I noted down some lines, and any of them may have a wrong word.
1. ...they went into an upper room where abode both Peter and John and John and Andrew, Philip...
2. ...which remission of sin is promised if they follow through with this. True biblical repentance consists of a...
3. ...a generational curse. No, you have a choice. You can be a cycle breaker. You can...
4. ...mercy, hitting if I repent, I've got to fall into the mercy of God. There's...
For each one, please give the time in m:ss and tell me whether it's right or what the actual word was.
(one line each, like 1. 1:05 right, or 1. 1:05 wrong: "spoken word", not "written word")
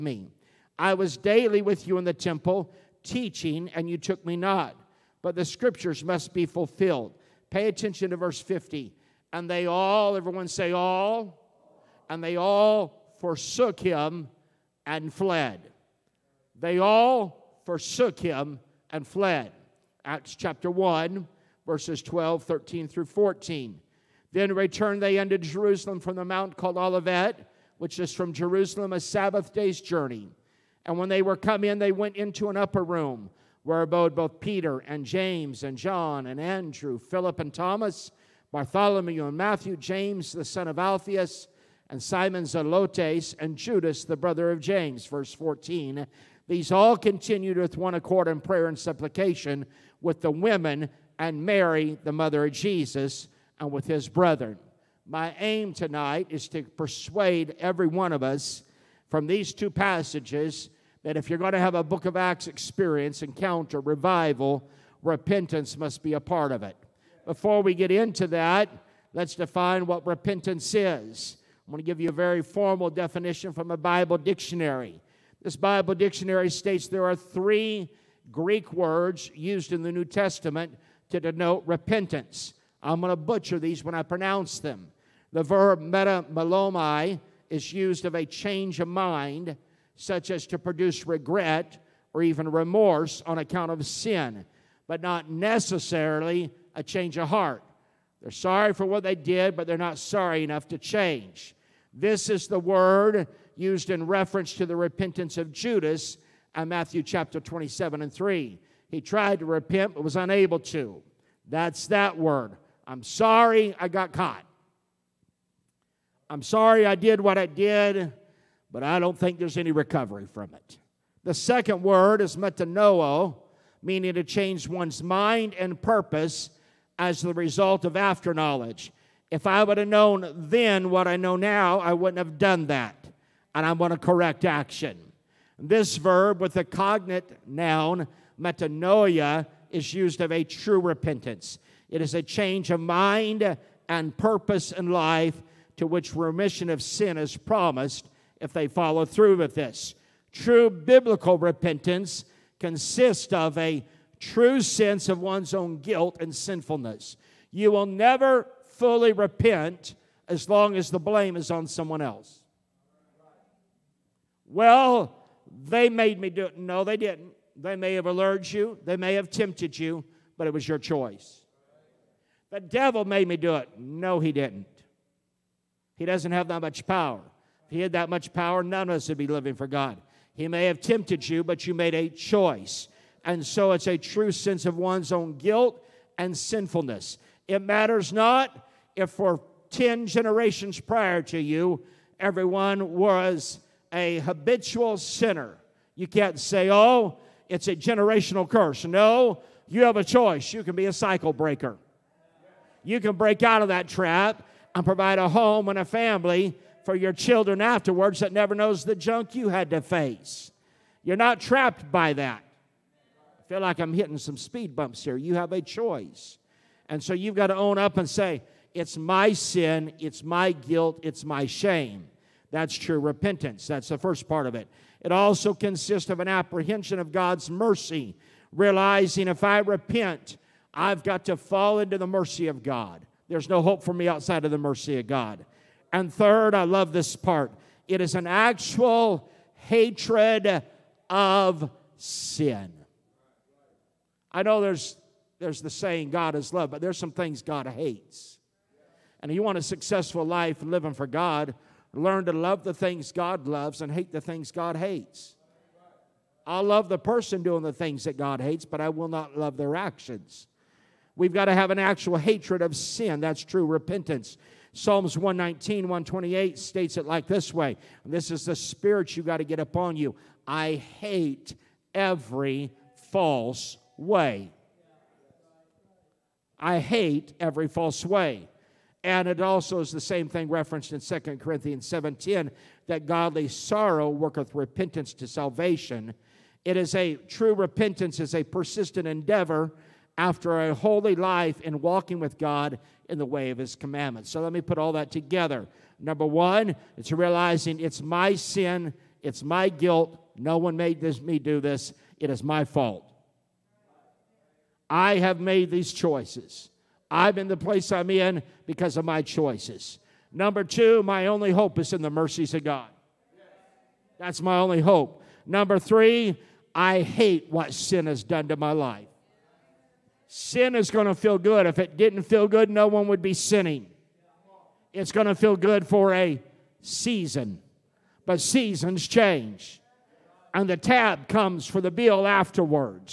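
1. 0:31 wrong: "James", not "John"
2. 2:25 right
3. 3:17 right
4. 3:47 wrong: "realizing", not "hitting".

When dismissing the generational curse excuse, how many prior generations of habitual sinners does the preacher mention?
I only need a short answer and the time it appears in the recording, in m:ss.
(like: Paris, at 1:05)
10, at 3:09.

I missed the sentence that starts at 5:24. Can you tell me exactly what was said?
It's going to feel good for a season, but seasons change.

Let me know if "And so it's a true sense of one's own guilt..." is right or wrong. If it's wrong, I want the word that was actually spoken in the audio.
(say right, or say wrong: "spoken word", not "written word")
right.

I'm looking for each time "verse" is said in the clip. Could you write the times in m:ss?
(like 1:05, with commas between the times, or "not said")
0:08, 0:21, 0:45.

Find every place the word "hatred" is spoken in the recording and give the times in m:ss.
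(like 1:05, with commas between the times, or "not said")
3:59, 4:22.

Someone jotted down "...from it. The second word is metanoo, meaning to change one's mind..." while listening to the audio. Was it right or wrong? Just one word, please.
right.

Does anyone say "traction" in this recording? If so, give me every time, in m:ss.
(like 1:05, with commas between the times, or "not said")
not said.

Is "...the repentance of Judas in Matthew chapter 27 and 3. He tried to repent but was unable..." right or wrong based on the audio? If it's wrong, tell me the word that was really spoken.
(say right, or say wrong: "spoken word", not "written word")
right.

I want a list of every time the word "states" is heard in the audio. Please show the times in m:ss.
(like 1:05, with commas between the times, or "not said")
1:16, 4:26.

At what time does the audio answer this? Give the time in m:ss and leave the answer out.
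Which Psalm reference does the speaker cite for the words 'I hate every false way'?
4:24.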